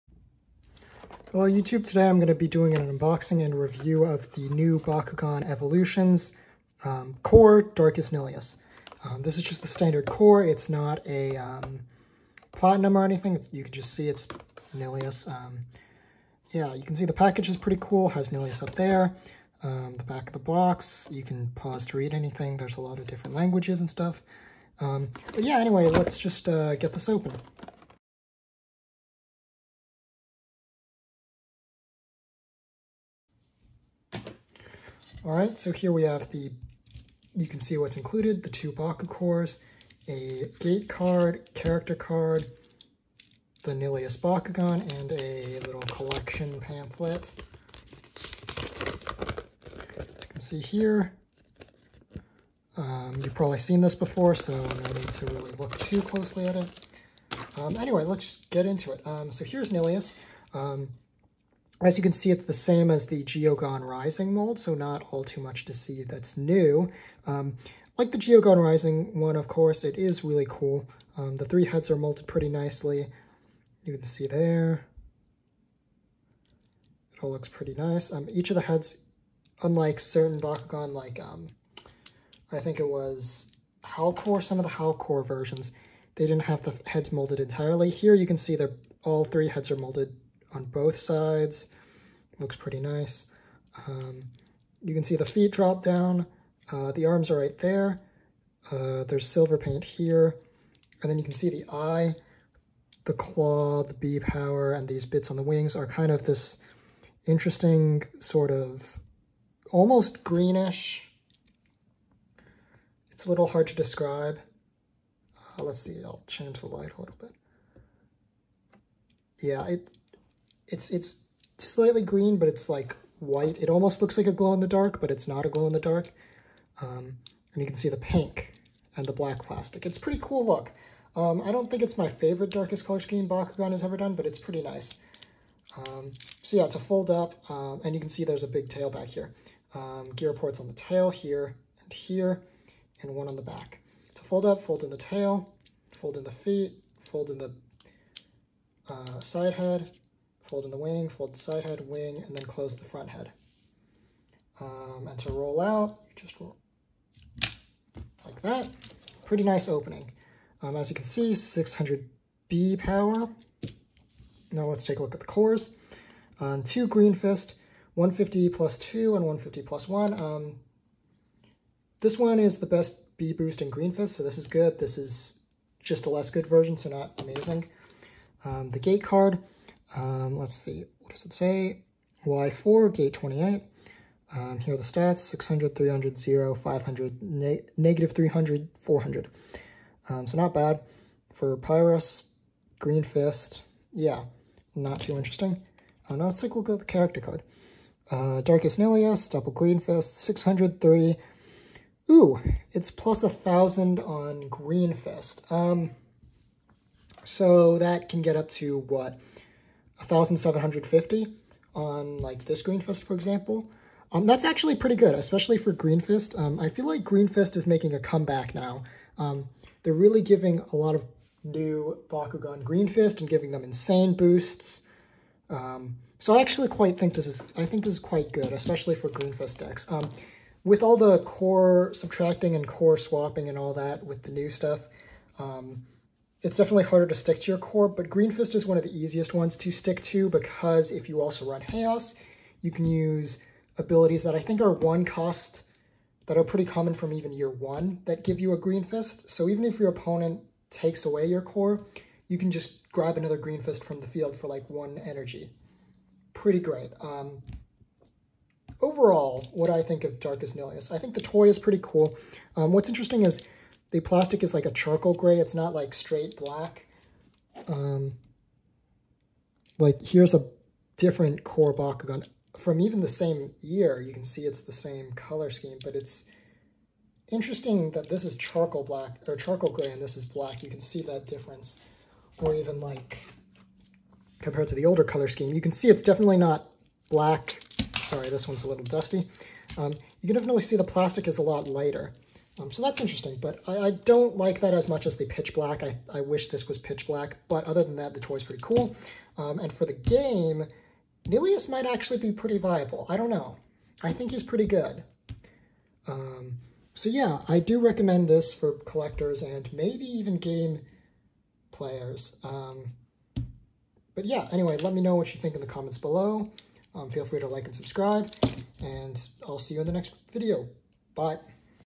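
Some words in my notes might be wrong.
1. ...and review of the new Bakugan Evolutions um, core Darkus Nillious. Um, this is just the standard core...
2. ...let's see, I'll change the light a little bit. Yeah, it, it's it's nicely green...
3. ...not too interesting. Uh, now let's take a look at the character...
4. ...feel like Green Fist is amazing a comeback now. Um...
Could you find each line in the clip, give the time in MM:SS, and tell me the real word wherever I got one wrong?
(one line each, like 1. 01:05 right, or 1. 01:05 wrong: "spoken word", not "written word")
1. 00:03 right
2. 01:55 wrong: "slightly", not "nicely"
3. 03:14 right
4. 03:36 wrong: "making", not "amazing".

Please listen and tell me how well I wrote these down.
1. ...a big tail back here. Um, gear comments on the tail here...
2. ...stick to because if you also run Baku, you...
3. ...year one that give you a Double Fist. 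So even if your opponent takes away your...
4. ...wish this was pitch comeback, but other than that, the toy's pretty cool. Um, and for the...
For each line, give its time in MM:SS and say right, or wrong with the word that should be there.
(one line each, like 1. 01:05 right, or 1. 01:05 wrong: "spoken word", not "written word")
1. 02:18 wrong: "ports", not "comments"
2. 03:59 wrong: "Chaos", not "Baku"
3. 04:07 wrong: "Green", not "Double"
4. 04:56 wrong: "black", not "comeback".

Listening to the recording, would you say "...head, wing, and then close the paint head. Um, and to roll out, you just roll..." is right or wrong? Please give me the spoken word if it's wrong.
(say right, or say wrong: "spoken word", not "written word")
wrong: "front", not "paint".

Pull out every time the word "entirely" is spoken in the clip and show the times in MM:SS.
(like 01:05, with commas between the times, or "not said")
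01:27.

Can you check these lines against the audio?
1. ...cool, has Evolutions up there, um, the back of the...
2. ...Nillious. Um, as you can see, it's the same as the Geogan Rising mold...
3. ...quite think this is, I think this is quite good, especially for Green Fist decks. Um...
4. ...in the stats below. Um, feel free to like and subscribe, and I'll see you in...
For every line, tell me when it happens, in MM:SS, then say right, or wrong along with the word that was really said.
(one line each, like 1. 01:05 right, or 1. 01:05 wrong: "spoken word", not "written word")
1. 00:17 wrong: "Nillious", not "Evolutions"
2. 00:59 right
3. 03:46 right
4. 05:15 wrong: "comments", not "stats".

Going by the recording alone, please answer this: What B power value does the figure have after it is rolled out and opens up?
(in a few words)
600.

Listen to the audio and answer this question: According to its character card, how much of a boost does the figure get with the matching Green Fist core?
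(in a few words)
1,000.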